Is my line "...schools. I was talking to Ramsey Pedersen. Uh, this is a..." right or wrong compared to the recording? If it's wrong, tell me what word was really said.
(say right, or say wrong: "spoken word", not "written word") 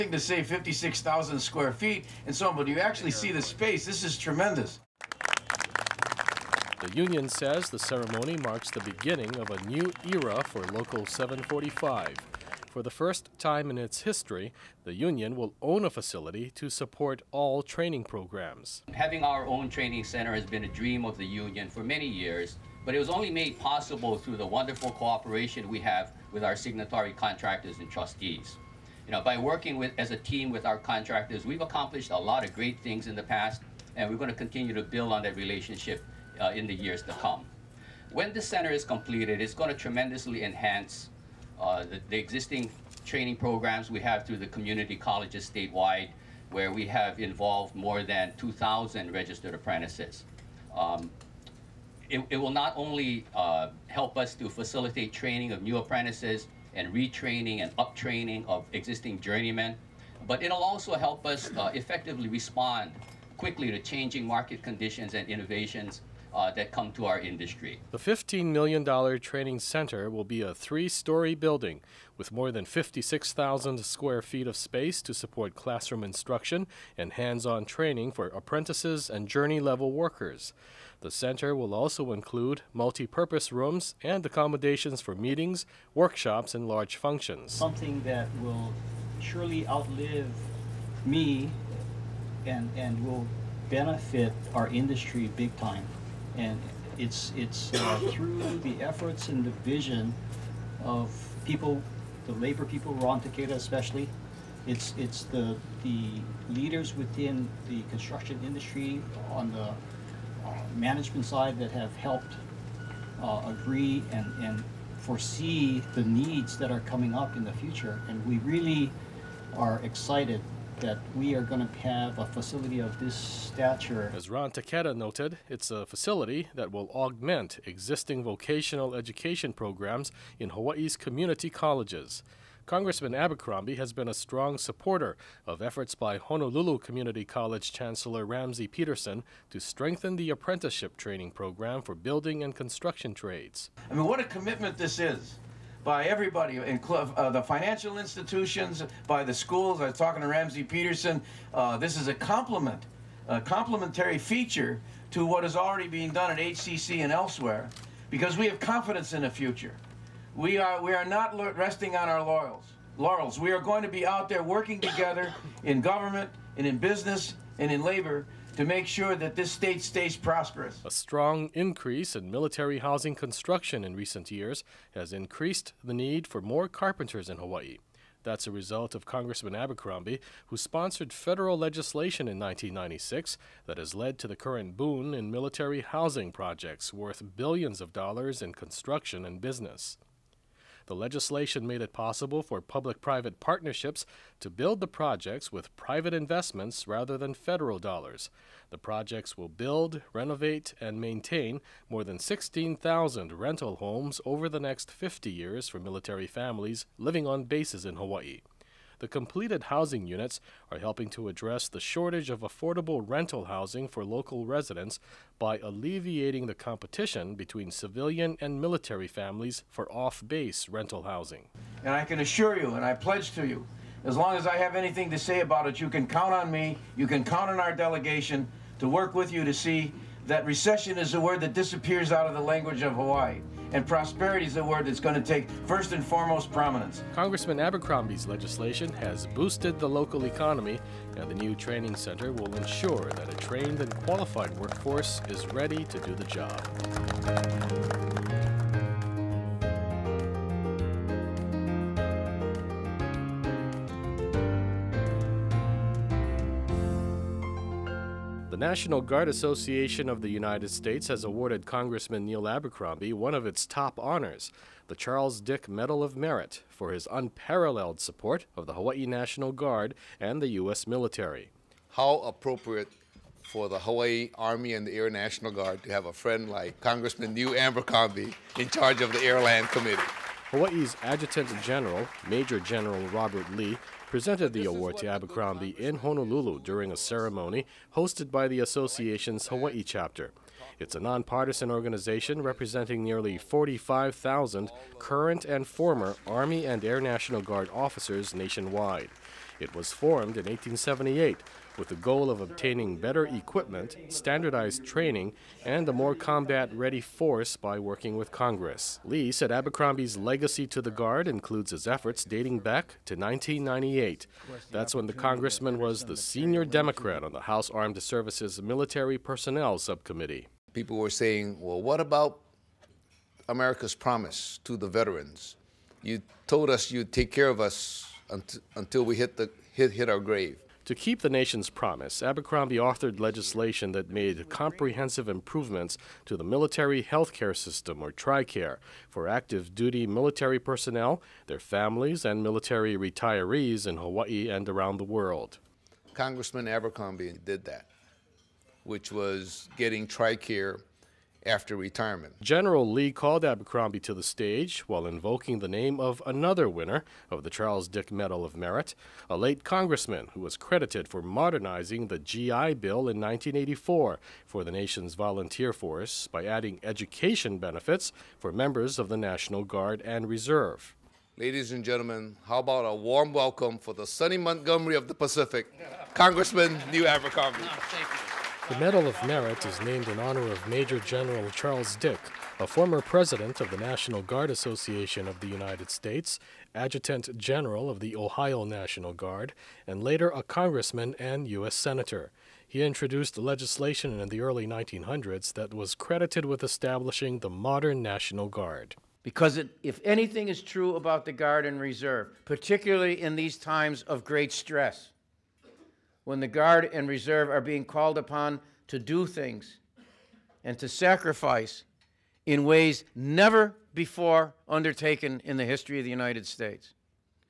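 right.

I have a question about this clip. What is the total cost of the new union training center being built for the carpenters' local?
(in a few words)
$15 million.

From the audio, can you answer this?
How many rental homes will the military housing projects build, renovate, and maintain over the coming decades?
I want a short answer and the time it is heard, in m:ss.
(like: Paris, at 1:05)
16,000, at 3:22.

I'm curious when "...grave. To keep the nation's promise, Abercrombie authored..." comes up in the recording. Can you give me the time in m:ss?
5:30.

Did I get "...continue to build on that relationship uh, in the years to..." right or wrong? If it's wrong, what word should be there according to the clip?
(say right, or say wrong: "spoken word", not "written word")
right.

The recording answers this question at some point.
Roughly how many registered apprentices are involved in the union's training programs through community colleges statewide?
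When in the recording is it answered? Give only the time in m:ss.
0:48.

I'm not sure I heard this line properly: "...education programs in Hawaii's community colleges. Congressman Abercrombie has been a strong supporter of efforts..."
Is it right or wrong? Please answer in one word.
right.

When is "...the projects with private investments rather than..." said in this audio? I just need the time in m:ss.
3:14.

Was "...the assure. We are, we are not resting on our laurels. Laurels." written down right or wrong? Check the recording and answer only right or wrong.
wrong.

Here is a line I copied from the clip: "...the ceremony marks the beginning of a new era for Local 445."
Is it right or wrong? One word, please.
wrong.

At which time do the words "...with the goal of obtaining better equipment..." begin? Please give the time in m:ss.
5:01.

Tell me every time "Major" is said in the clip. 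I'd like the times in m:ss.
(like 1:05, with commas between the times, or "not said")
4:42, 6:20.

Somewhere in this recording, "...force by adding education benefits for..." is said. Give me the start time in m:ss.
6:05.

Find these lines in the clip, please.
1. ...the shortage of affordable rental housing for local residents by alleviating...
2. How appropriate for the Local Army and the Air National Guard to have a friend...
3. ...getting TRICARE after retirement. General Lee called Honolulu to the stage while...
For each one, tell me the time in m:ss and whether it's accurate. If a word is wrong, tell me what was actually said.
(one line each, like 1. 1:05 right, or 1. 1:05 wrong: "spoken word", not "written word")
1. 3:31 right
2. 4:31 wrong: "Hawaii", not "Local"
3. 5:49 wrong: "Abercrombie", not "Honolulu".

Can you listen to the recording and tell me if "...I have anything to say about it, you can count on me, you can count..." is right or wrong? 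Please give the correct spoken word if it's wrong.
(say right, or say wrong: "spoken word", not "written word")
right.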